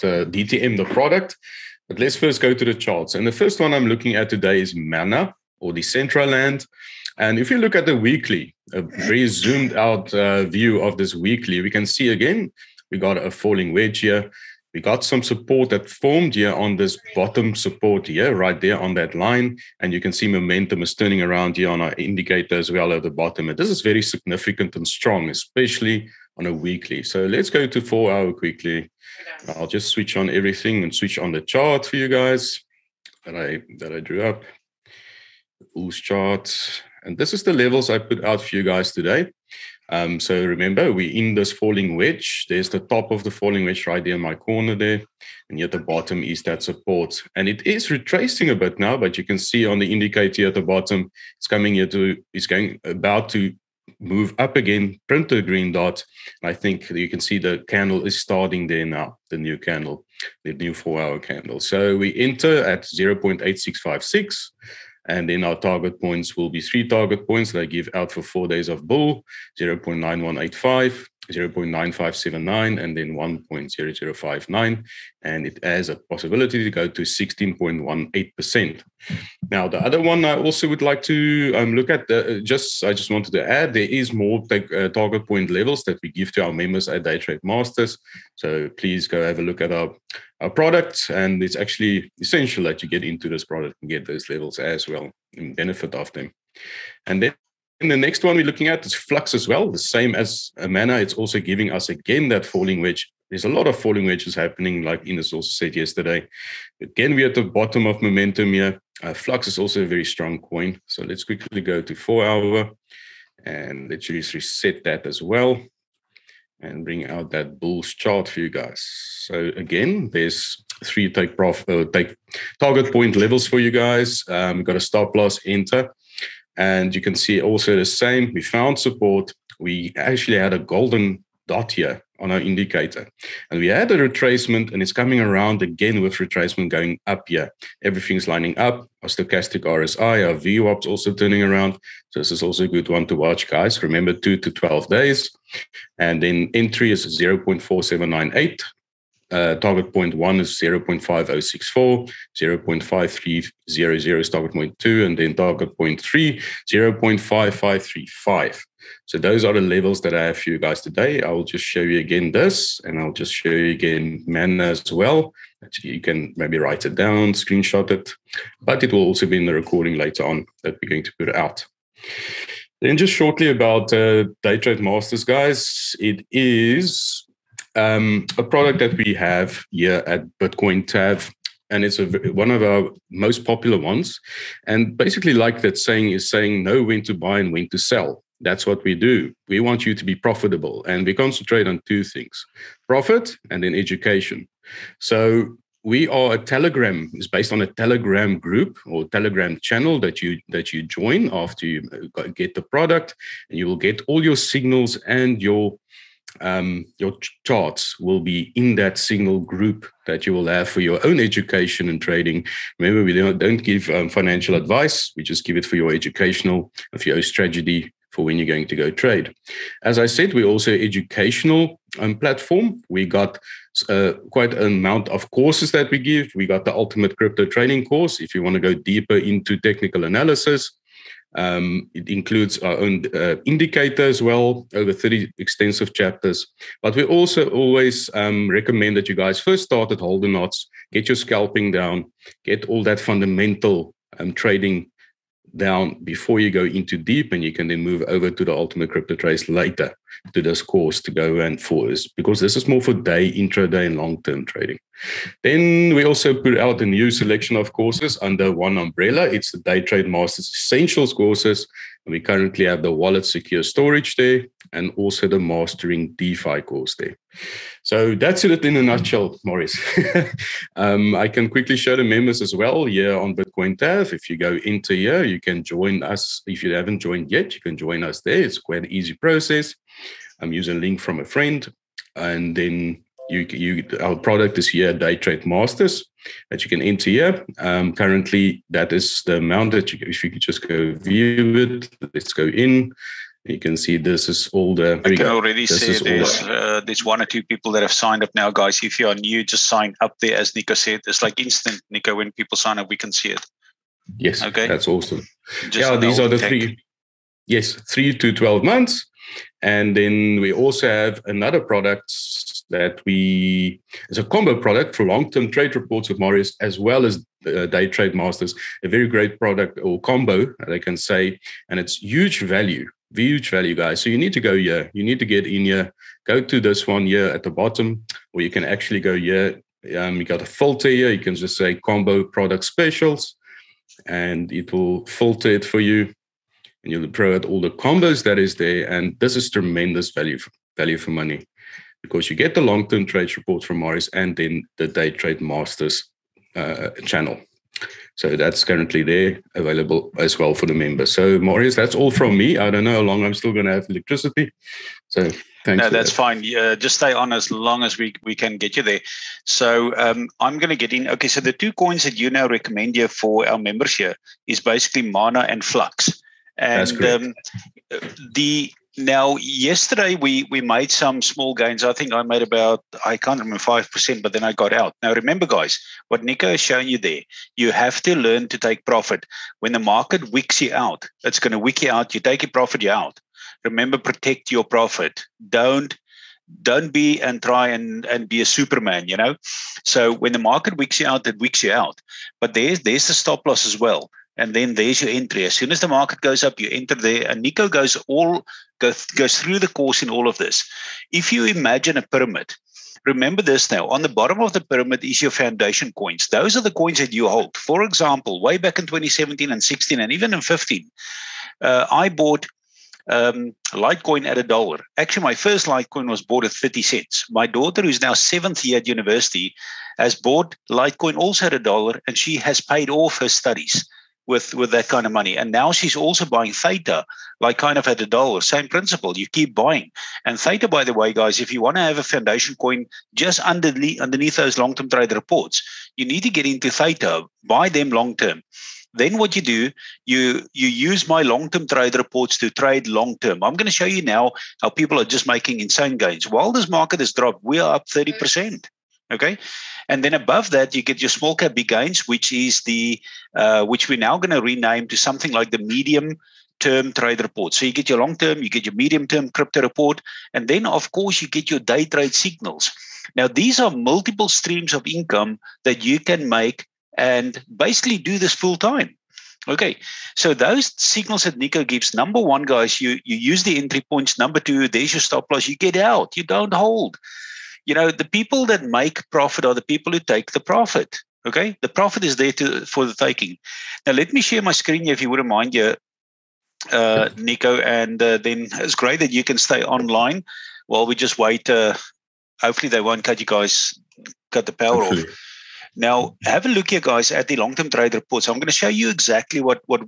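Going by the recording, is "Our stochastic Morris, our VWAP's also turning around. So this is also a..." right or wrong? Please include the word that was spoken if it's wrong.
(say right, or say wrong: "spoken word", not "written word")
wrong: "RSI", not "Morris".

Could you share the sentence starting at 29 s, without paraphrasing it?
I'll just switch on everything and switch on the chart for you guys that I that I drew up ooze charts.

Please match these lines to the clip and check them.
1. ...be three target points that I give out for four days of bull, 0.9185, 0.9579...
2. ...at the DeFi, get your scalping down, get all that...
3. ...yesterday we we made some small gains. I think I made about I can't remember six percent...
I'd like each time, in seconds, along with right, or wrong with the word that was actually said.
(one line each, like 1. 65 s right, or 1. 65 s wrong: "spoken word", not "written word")
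1. 66 s right
2. 239 s wrong: "Knots", not "DeFi"
3. 369 s wrong: "five", not "six".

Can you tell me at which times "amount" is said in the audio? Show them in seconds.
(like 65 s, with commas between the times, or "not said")
224 s, 289 s.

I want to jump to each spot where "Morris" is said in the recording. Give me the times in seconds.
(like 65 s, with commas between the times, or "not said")
269 s, 343 s.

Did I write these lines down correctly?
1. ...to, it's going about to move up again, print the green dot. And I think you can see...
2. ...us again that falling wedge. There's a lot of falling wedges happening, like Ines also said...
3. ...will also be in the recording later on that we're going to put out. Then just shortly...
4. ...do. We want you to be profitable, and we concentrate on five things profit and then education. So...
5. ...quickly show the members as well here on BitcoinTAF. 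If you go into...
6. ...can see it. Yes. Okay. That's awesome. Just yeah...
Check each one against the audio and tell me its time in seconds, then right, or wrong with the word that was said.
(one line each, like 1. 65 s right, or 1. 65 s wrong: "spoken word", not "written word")
1. 51 s right
2. 101 s right
3. 168 s right
4. 188 s wrong: "two", not "five"
5. 271 s right
6. 302 s right.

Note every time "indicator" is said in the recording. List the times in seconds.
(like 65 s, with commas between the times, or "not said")
21 s, 49 s, 132 s, 233 s.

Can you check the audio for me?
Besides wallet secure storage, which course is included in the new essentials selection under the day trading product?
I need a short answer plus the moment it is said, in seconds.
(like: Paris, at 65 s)
Mastering DeFi, at 265 s.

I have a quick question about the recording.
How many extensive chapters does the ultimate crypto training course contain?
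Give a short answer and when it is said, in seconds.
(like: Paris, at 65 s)
over 30, at 234 s.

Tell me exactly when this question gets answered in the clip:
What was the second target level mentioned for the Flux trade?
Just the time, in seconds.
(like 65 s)
152 s.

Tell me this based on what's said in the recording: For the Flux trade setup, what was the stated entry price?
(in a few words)
0.4798.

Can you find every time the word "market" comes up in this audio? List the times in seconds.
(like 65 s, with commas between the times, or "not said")
379 s, 390 s, 395 s, 446 s.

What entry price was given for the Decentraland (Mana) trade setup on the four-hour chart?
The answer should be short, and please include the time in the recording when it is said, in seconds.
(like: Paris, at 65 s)
0.8656, at 62 s.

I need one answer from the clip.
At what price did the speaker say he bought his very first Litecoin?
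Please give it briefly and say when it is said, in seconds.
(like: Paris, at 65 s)
30 cents, at 416 s.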